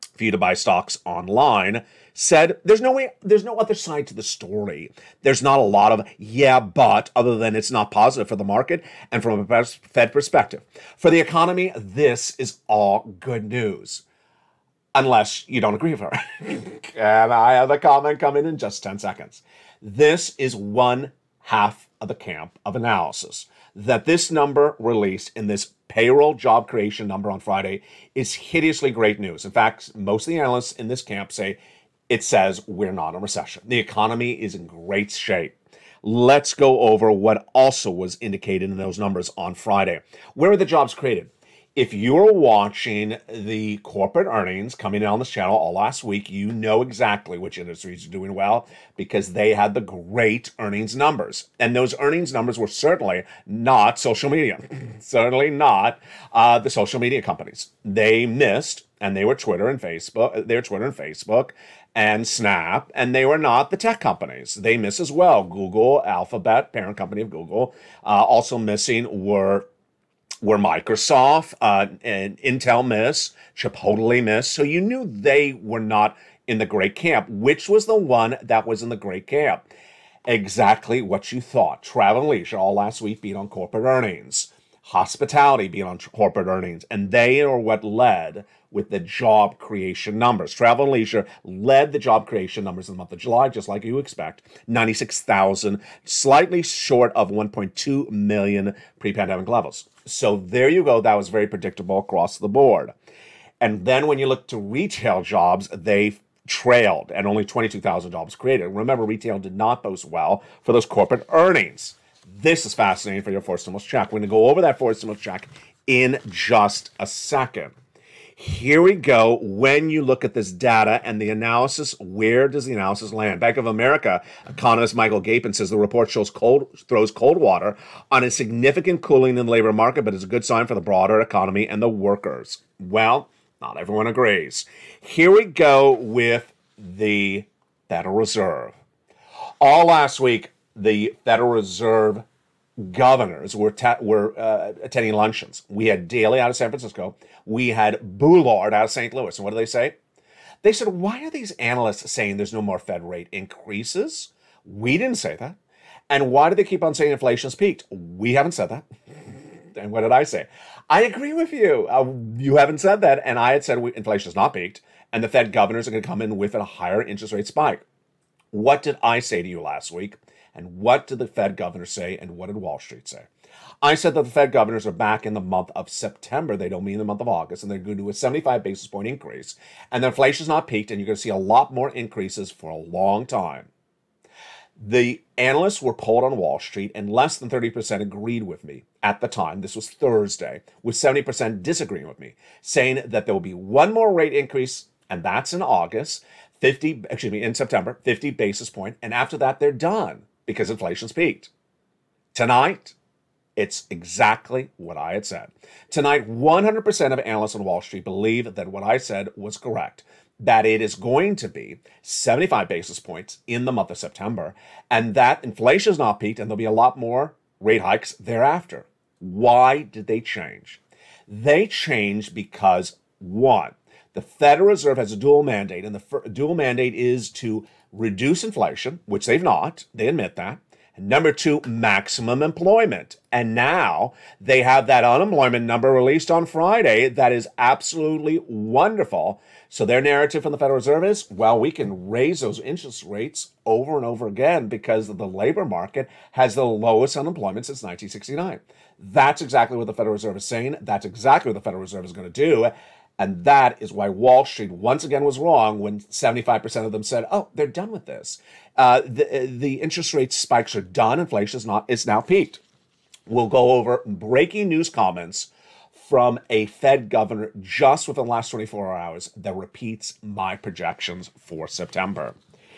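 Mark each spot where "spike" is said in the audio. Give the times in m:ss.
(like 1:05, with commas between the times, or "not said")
2:47, 4:20.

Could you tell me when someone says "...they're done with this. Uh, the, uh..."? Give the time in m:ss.
4:17.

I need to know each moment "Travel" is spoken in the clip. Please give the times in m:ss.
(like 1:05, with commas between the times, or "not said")
1:21, 1:30.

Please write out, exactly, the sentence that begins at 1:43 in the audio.
And then when you look to retail jobs, they trailed and only 22,000 jobs created.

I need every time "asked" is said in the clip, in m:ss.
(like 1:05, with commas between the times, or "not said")
not said.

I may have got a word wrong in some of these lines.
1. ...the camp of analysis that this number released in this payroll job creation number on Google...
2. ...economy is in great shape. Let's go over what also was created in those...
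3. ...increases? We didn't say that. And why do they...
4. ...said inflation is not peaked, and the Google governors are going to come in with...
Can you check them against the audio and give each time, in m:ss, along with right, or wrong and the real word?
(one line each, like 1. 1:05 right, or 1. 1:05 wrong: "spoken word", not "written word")
1. 0:22 wrong: "Friday", not "Google"
2. 0:33 wrong: "indicated", not "created"
3. 2:33 right
4. 2:43 wrong: "Fed", not "Google".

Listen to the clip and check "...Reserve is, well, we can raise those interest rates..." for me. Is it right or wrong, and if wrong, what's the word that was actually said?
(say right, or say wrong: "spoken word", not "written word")
right.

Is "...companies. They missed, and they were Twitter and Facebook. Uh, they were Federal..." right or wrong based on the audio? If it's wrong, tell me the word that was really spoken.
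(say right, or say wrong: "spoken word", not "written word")
wrong: "Twitter", not "Federal".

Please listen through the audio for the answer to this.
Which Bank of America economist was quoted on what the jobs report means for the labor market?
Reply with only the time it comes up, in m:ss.
2:04.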